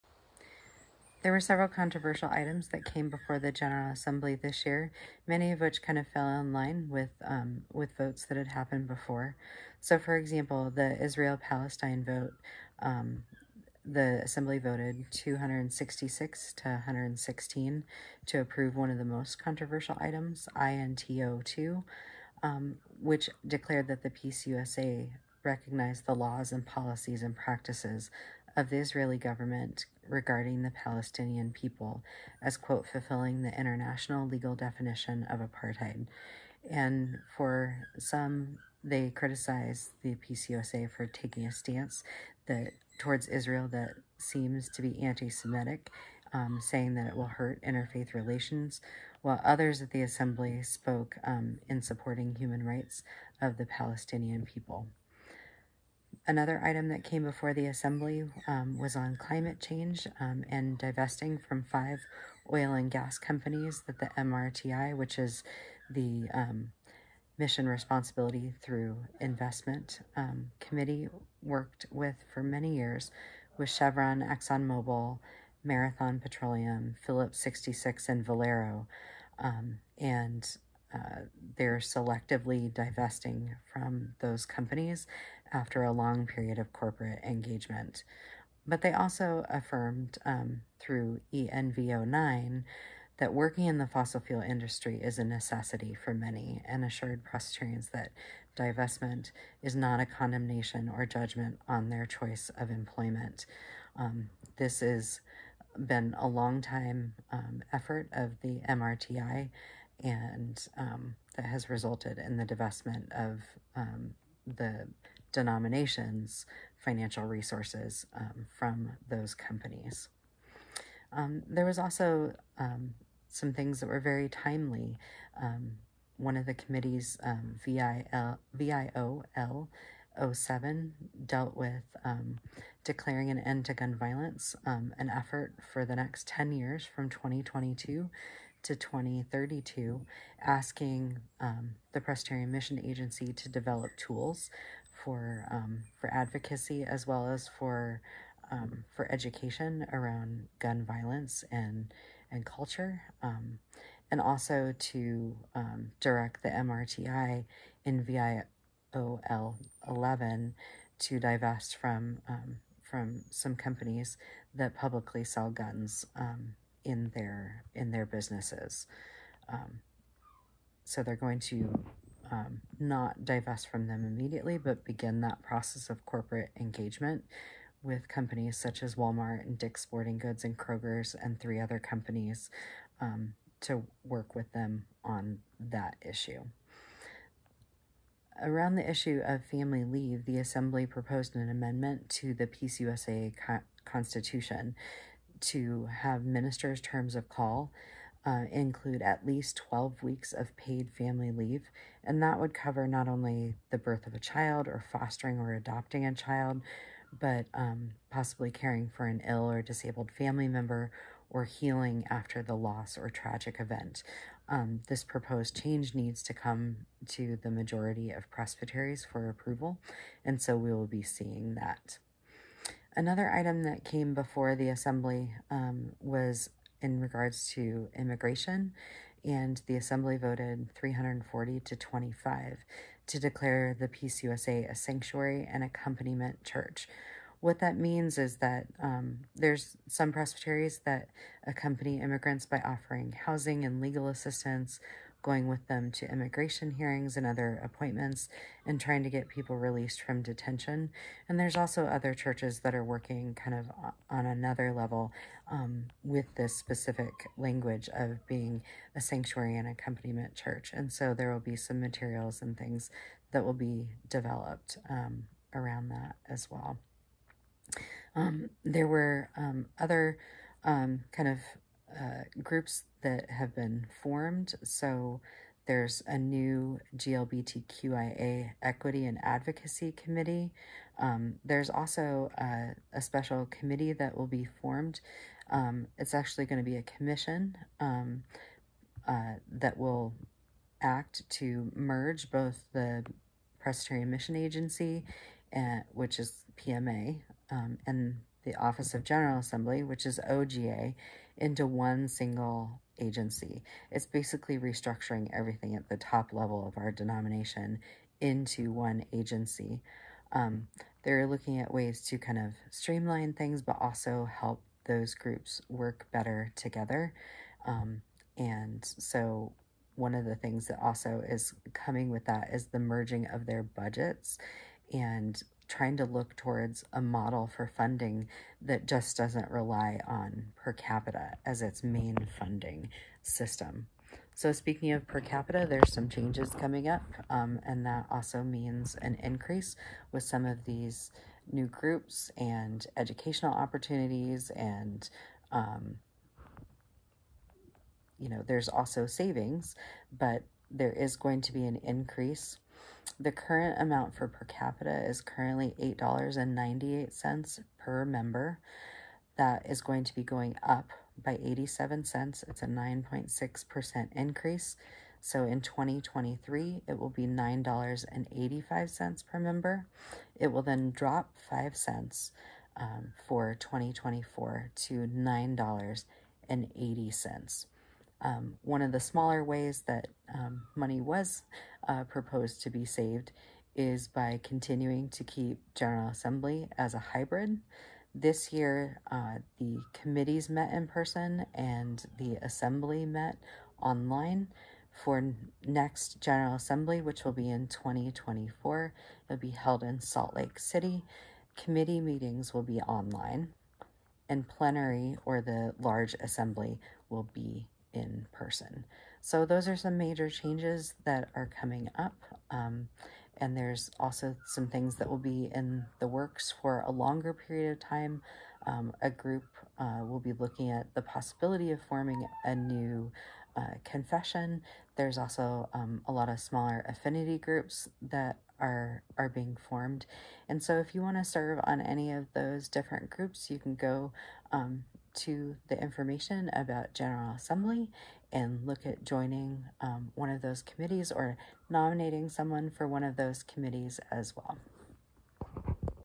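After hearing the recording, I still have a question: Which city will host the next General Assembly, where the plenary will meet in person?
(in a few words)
Salt Lake City.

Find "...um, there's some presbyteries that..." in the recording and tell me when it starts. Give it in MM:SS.
03:58.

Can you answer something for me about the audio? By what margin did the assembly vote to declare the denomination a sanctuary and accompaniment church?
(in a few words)
340 to 25.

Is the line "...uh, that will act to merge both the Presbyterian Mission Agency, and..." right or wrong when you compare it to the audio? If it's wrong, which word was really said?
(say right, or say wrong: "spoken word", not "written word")
right.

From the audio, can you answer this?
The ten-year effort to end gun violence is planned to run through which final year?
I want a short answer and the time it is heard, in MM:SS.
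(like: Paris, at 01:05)
2032, at 02:18.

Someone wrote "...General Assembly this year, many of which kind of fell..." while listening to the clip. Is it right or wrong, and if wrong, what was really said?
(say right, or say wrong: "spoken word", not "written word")
right.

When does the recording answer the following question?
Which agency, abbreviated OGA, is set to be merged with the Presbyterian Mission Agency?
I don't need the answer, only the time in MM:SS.
04:58.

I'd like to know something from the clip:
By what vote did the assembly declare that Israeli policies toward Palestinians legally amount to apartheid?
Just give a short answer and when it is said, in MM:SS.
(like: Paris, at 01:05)
266 to 116, at 00:15.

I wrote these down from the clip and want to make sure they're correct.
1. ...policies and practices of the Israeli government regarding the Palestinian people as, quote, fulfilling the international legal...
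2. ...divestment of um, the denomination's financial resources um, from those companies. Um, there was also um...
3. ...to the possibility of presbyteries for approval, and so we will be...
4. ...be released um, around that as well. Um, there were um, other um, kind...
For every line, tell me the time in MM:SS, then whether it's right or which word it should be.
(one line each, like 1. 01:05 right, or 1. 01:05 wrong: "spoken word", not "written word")
1. 00:26 right
2. 01:52 right
3. 03:37 wrong: "majority", not "possibility"
4. 04:23 wrong: "developed", not "released".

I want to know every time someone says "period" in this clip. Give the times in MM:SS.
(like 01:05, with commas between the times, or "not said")
01:26, 06:57.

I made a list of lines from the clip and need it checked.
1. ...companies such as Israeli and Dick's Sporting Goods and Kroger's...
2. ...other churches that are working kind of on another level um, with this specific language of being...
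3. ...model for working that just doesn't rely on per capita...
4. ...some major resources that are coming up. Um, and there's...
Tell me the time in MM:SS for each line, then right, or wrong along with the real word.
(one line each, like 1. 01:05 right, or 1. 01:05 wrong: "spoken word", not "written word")
1. 02:58 wrong: "Walmart", not "Israeli"
2. 04:11 right
3. 05:27 wrong: "funding", not "working"
4. 06:49 wrong: "changes", not "resources".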